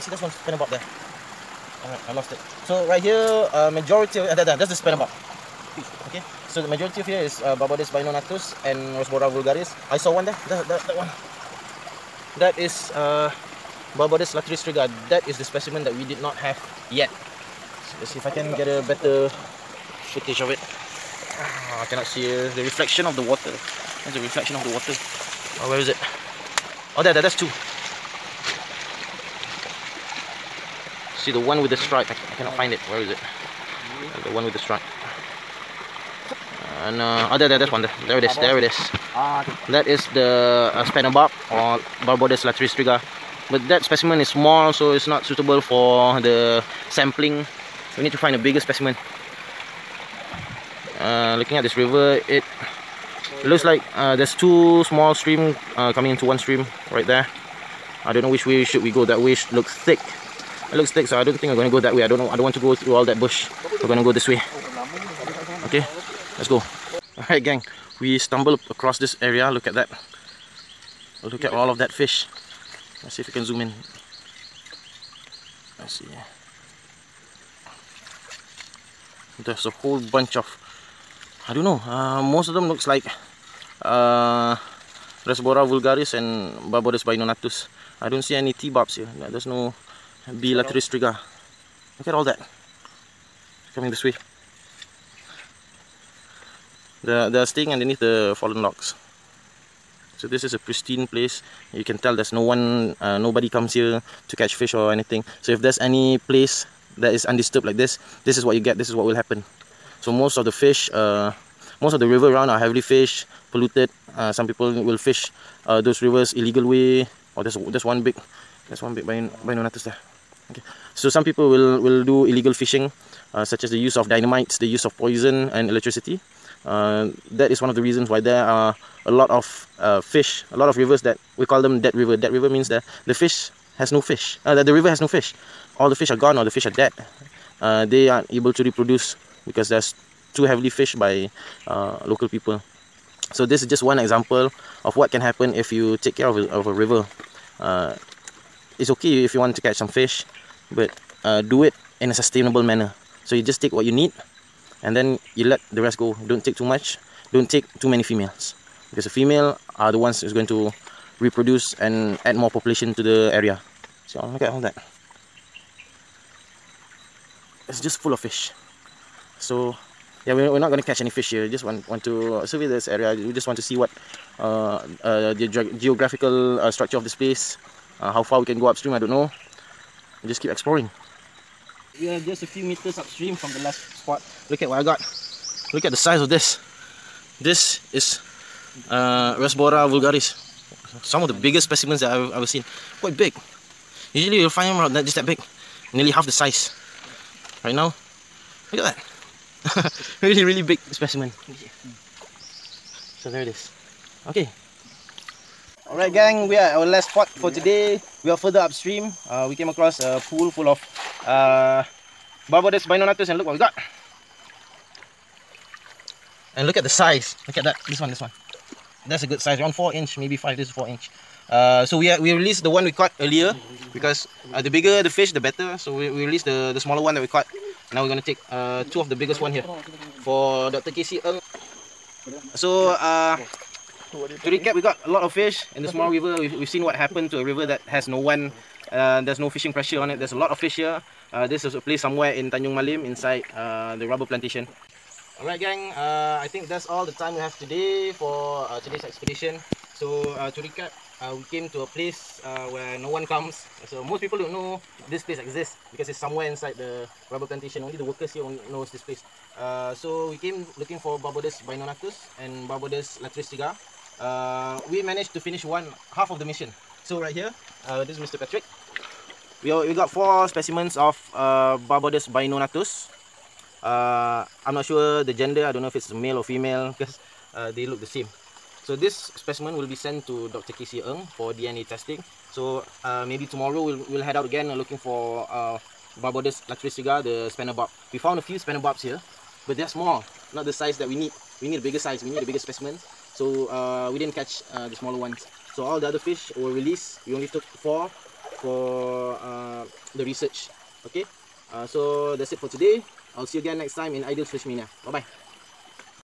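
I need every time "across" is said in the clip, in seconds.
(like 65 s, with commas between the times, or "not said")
68 s, 209 s.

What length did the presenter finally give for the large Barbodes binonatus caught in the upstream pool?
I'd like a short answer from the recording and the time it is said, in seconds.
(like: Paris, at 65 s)
4 inch, at 220 s.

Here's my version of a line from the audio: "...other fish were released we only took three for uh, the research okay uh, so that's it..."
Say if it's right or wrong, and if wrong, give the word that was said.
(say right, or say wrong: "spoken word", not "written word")
wrong: "four", not "three".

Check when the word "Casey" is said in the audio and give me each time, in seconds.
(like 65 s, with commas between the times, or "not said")
230 s, 280 s.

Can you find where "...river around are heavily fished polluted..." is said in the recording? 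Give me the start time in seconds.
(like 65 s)
112 s.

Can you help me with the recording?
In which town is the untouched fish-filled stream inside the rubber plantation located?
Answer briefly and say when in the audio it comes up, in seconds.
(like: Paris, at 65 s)
Tanjung Malim, at 242 s.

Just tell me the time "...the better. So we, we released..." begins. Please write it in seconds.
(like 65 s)
225 s.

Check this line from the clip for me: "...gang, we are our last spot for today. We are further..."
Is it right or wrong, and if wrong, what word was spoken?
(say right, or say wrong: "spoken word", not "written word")
right.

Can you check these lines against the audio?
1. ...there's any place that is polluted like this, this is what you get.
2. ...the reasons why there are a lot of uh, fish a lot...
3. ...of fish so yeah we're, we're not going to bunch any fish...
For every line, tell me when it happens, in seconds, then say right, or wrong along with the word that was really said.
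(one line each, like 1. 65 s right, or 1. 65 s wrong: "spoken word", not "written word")
1. 105 s wrong: "undisturbed", not "polluted"
2. 127 s right
3. 168 s wrong: "catch", not "bunch".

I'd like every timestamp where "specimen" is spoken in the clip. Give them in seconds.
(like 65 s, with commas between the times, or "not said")
15 s, 43 s, 48 s, 191 s, 200 s, 270 s, 279 s, 292 s.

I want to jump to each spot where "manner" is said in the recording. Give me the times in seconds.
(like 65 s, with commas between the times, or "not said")
152 s.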